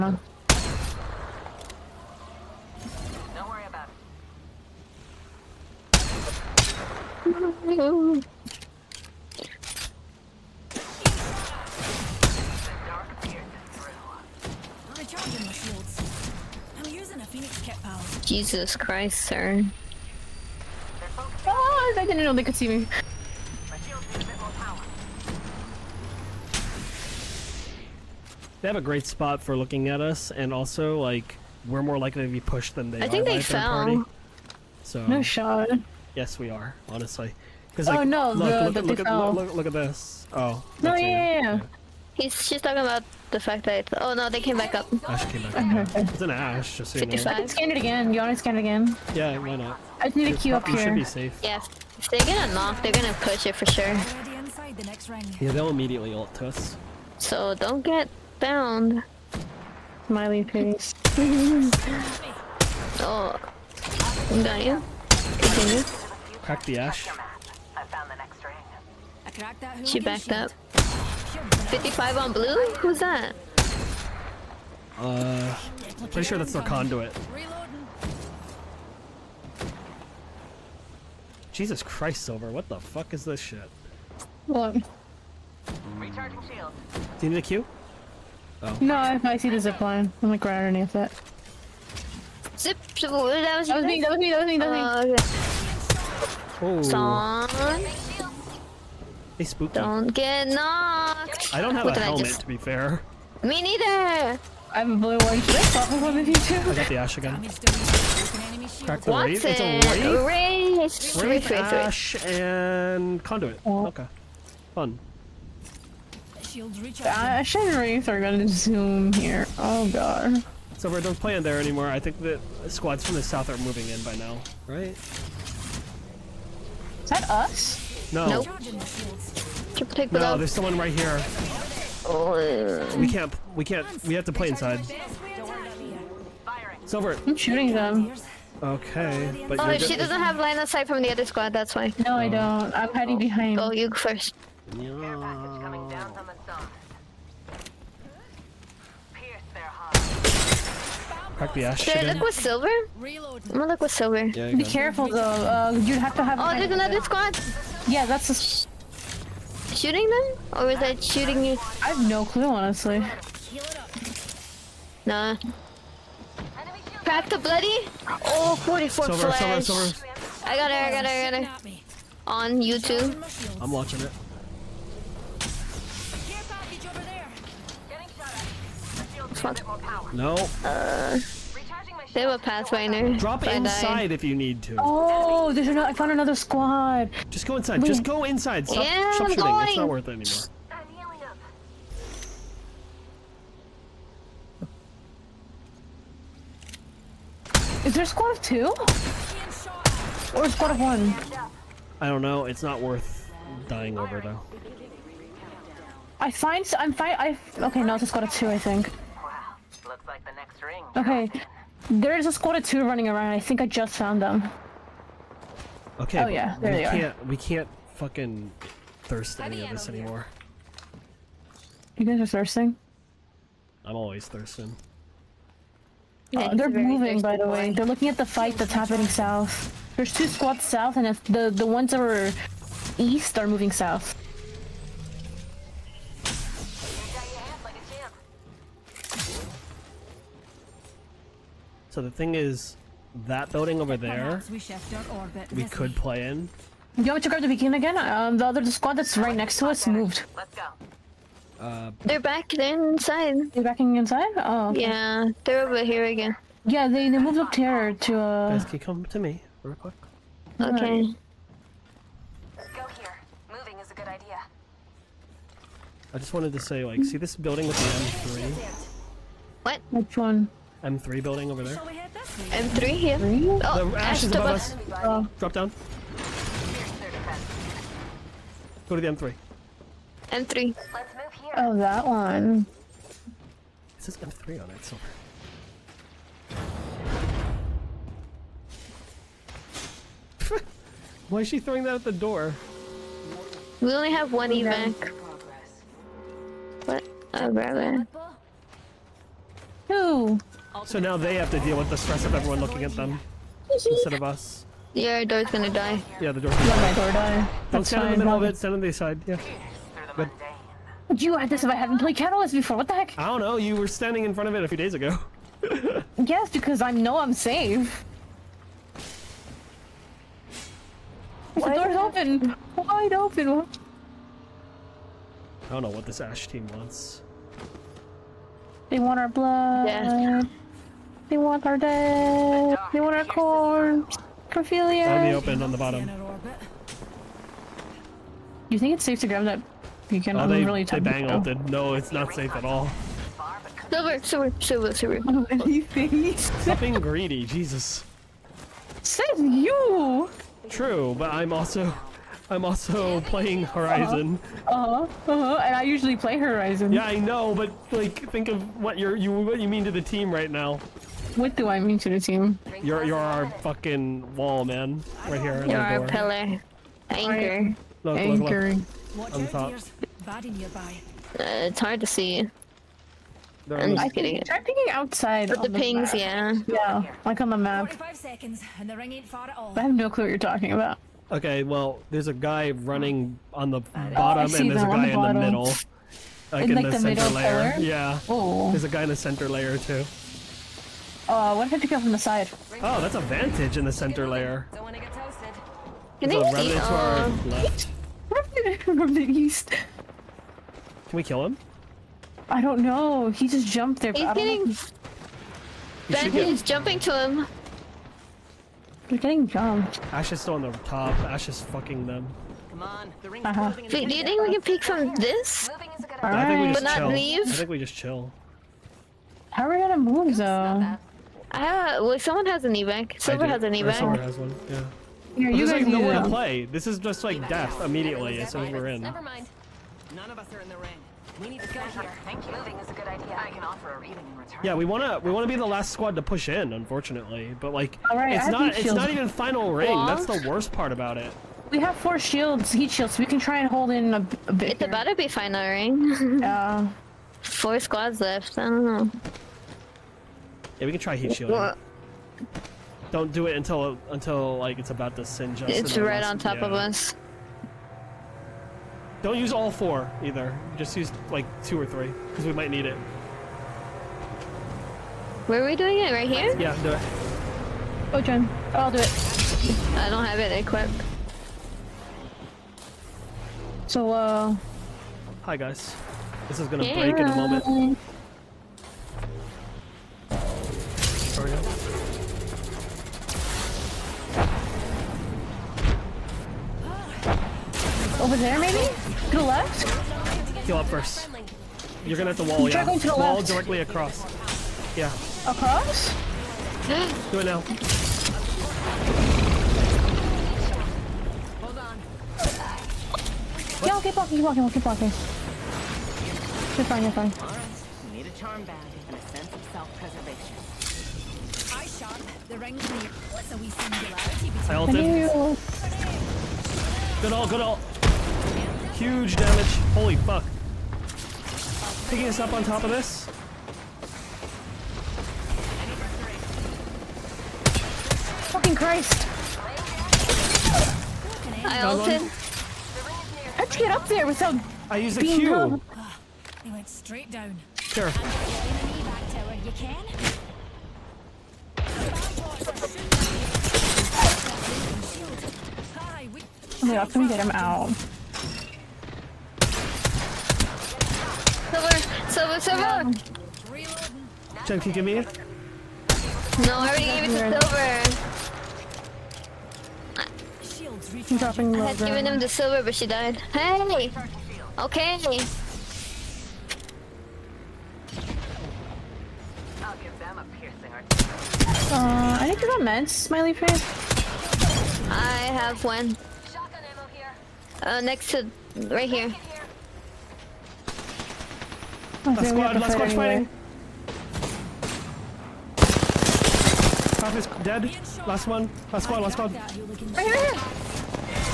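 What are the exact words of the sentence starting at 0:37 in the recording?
Because oh, like, oh no, look, the, look, the look, look, at, look, look, at this.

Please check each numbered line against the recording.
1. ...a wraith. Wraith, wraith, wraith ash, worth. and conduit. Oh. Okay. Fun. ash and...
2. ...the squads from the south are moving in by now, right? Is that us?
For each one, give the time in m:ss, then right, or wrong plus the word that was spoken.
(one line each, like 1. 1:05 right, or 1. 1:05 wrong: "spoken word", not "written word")
1. 1:49 wrong: "wraith", not "worth"
2. 2:02 right.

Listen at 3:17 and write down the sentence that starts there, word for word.
Is there a squad of two?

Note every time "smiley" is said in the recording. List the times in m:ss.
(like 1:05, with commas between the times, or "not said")
1:00, 9:33.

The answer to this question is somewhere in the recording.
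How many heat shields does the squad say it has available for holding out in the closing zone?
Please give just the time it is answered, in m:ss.
7:21.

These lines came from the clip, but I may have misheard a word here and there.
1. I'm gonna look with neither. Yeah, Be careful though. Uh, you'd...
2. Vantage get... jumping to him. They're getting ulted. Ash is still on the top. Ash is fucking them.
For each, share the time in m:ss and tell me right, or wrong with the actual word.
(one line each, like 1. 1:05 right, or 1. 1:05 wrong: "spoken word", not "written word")
1. 2:32 wrong: "silver", not "neither"
2. 6:46 wrong: "jumped", not "ulted".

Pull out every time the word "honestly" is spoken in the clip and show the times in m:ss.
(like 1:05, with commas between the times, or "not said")
0:36, 2:42.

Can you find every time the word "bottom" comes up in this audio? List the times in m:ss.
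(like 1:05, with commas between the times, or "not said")
5:35, 6:23.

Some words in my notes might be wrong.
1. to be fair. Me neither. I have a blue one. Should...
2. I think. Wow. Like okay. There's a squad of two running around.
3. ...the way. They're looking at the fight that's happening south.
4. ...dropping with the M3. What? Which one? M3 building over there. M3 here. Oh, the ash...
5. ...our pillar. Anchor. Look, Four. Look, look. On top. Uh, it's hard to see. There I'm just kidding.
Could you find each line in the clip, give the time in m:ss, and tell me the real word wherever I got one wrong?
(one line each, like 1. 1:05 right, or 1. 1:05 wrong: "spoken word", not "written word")
1. 1:42 right
2. 3:28 right
3. 3:47 right
4. 4:27 wrong: "building", not "dropping"
5. 6:05 wrong: "Anchoring", not "Four".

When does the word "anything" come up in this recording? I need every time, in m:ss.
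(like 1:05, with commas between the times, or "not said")
5:45.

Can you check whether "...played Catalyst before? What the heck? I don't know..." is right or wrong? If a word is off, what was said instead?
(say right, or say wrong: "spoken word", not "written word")
right.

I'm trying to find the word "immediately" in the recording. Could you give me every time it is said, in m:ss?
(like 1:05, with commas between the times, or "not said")
0:55, 7:07.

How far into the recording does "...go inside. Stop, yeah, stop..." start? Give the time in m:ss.
3:08.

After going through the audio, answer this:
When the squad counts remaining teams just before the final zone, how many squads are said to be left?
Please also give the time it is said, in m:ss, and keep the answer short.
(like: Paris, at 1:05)
4, at 7:27.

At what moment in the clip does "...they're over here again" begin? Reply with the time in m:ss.
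4:15.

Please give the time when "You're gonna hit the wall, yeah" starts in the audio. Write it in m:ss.
8:12.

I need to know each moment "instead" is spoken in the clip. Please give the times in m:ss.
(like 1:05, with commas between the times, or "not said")
5:03.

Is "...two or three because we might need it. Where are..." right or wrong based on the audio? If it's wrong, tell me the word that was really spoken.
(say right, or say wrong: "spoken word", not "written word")
right.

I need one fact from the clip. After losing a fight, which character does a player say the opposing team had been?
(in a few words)
Pathfinder.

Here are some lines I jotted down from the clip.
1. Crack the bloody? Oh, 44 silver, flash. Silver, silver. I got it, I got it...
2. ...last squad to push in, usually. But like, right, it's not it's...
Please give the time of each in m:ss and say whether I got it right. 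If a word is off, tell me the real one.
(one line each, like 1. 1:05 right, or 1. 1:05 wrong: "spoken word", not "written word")
1. 2:47 right
2. 7:15 wrong: "unfortunately", not "usually".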